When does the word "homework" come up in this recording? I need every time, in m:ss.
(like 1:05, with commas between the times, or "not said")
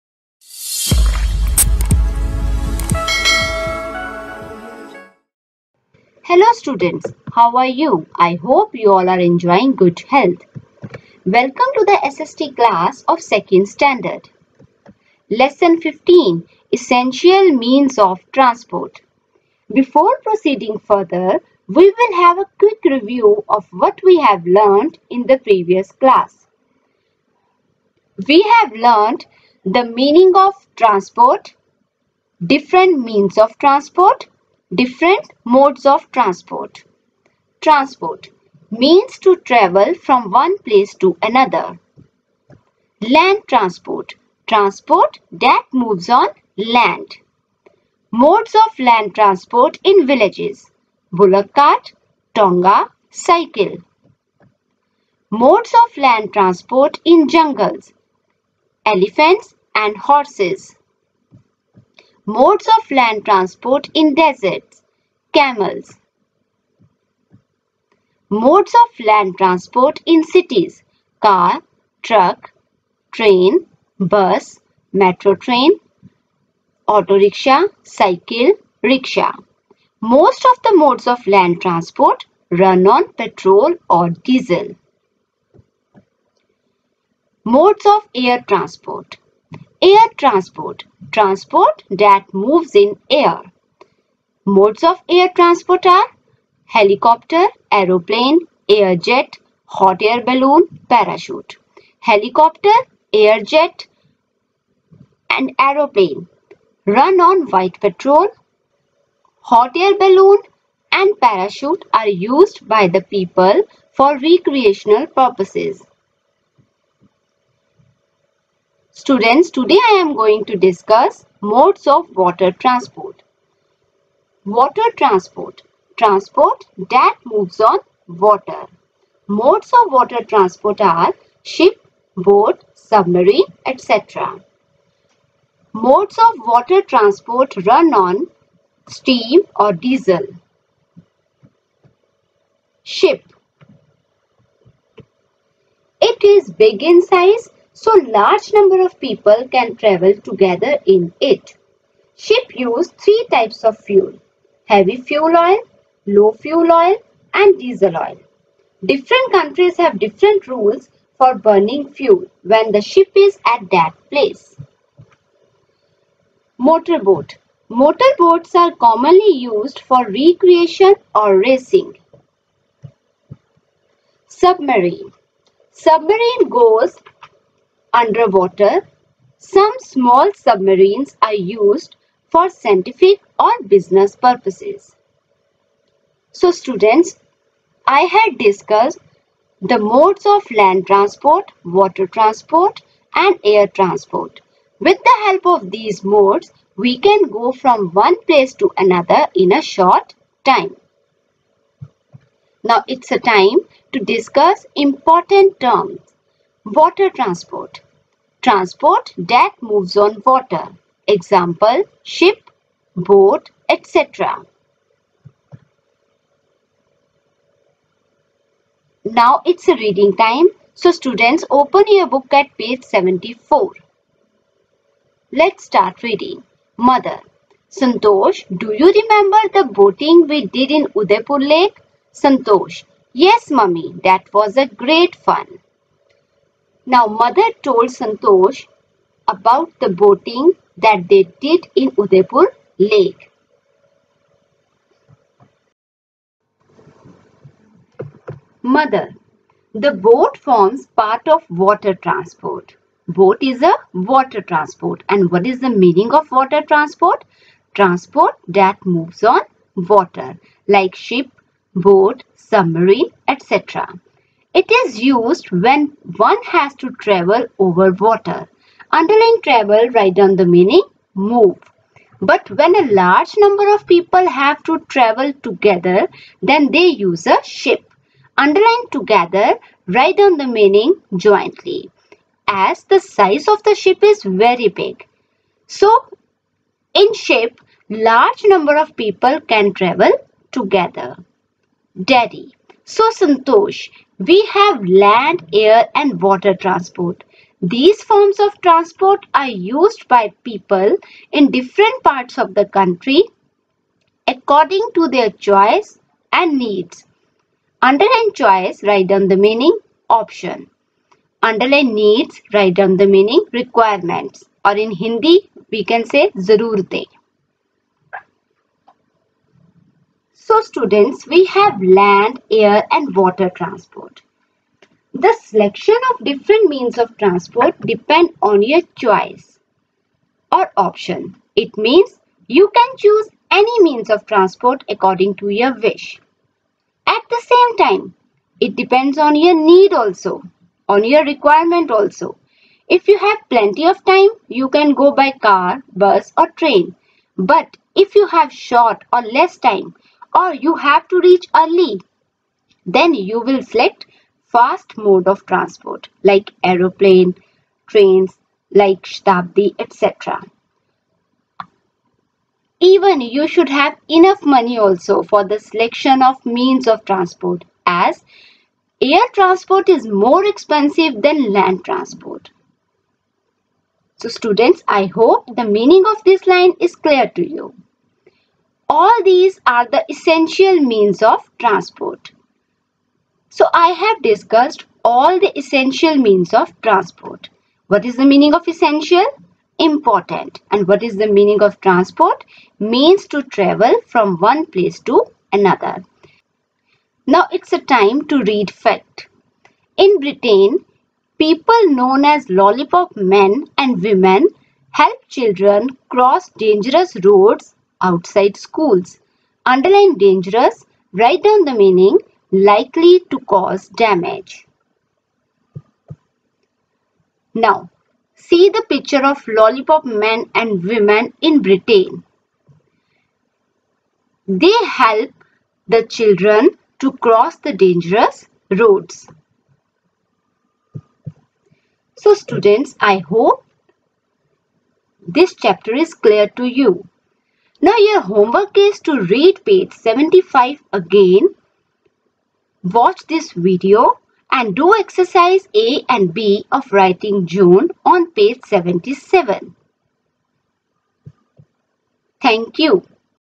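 7:18.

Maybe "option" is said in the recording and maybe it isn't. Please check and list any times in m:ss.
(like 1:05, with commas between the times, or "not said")
5:10, 5:30.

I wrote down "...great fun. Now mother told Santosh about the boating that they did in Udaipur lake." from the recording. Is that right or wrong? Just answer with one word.
right.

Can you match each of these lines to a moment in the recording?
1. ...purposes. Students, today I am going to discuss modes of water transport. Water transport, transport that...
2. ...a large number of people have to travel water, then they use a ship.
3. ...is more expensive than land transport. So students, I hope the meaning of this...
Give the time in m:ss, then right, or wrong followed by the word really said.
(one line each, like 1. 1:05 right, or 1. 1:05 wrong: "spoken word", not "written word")
1. 1:55 right
2. 4:32 wrong: "together", not "water"
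3. 6:09 right.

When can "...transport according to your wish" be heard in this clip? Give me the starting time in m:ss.
5:34.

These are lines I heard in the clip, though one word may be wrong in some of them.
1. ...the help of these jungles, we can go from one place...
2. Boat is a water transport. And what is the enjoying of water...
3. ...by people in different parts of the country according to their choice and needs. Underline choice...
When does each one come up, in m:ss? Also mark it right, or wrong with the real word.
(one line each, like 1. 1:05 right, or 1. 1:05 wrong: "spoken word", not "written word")
1. 3:15 wrong: "modes", not "jungles"
2. 4:13 wrong: "meaning", not "enjoying"
3. 5:00 right.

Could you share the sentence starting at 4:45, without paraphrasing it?
So, in ship, large number of people can travel together.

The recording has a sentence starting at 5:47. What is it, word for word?
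But if you have short or less time, or you have to reach early.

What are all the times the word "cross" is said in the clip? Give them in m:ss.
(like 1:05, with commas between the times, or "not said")
6:46, 7:07.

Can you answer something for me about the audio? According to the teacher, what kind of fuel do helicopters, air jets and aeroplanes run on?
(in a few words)
White petrol.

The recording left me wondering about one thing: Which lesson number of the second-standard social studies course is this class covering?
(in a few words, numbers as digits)
15.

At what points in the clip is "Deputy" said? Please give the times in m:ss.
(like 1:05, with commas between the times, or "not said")
not said.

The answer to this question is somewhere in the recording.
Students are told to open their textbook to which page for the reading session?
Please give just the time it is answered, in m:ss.
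3:42.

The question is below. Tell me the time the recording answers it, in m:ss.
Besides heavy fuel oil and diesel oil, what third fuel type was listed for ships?
2:36.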